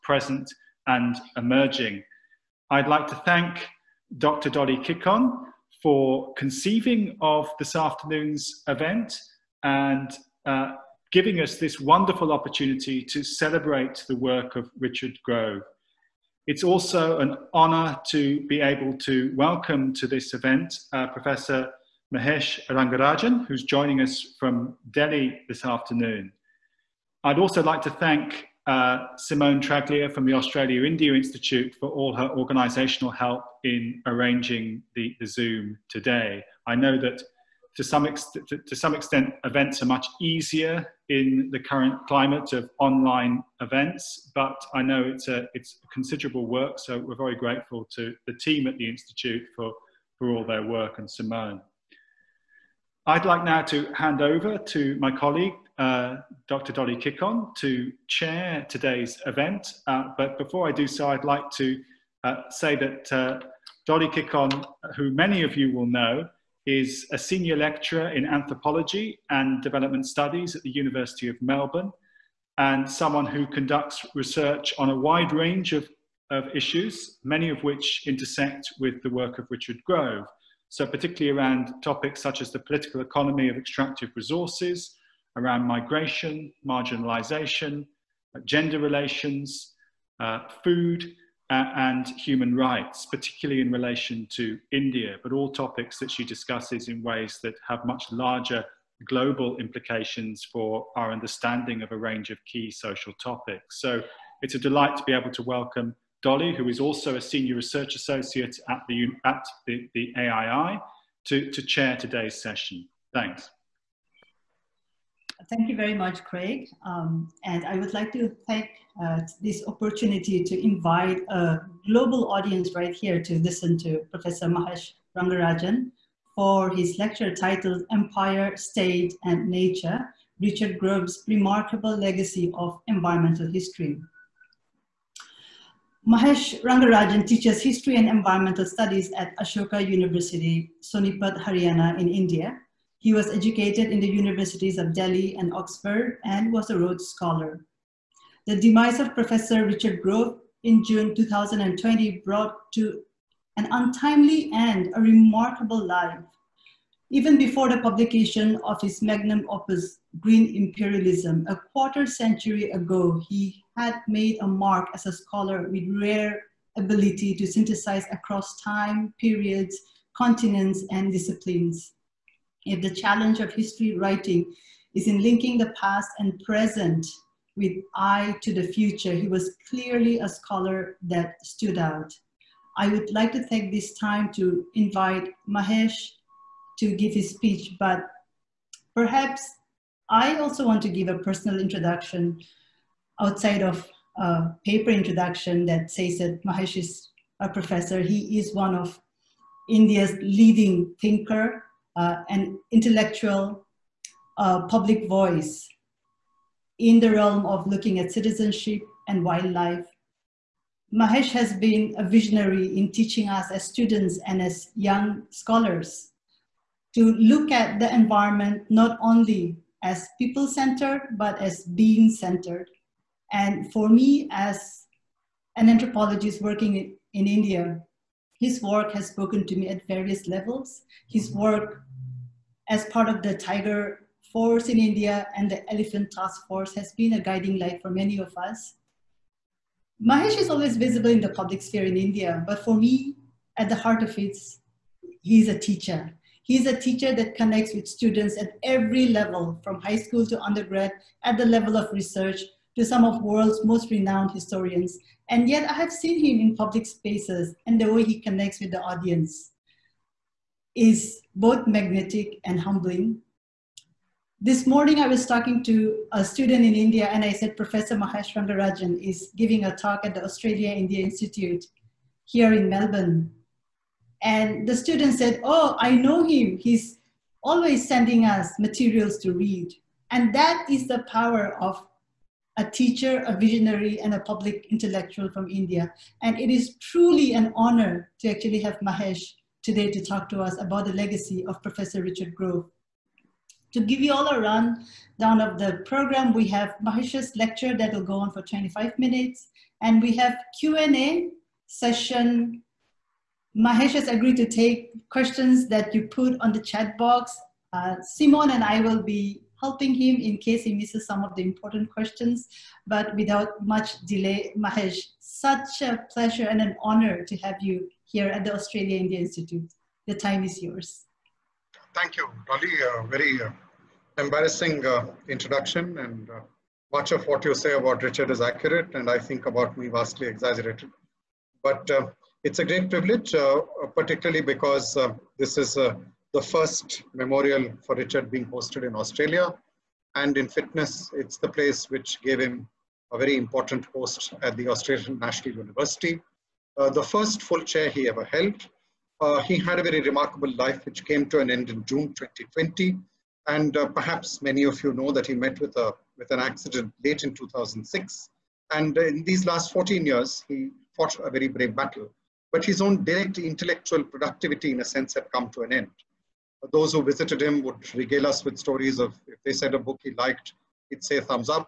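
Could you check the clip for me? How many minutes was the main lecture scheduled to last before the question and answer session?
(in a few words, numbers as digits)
25.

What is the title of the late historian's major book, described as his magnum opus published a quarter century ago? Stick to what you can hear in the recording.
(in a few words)
Green Imperialism.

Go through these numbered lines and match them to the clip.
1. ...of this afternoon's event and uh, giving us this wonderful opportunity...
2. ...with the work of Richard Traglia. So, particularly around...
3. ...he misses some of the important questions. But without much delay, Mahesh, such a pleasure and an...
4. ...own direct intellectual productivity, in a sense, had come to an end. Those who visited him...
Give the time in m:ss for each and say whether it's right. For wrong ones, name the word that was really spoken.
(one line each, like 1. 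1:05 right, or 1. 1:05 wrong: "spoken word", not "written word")
1. 0:07 right
2. 1:18 wrong: "Grove", not "Traglia"
3. 5:10 right
4. 6:02 right.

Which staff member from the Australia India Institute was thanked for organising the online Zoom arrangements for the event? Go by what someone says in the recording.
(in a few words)
Simone Traglia.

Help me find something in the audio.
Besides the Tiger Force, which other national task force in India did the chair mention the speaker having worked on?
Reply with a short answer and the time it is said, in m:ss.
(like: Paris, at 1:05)
Elephant Task Force, at 3:55.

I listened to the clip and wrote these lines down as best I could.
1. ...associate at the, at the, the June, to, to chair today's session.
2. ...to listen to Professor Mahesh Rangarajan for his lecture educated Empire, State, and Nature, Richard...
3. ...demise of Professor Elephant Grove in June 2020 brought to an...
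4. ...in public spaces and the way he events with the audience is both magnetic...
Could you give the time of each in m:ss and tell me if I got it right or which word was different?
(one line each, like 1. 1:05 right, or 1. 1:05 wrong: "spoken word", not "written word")
1. 1:47 wrong: "AII", not "June"
2. 2:03 wrong: "titled", not "educated"
3. 2:28 wrong: "Richard", not "Elephant"
4. 4:16 wrong: "connects", not "events".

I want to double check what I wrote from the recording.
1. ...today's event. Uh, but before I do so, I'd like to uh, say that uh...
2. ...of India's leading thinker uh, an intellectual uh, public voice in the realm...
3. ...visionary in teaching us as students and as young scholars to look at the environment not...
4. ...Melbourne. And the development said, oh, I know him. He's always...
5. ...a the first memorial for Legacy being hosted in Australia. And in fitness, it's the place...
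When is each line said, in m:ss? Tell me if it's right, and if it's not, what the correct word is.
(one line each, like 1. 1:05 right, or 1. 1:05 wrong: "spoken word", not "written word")
1. 0:58 right
2. 3:18 right
3. 3:32 right
4. 4:32 wrong: "student", not "development"
5. 5:35 wrong: "Richard", not "Legacy".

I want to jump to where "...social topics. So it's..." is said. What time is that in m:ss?
1:42.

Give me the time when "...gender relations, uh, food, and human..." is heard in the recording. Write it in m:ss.
1:28.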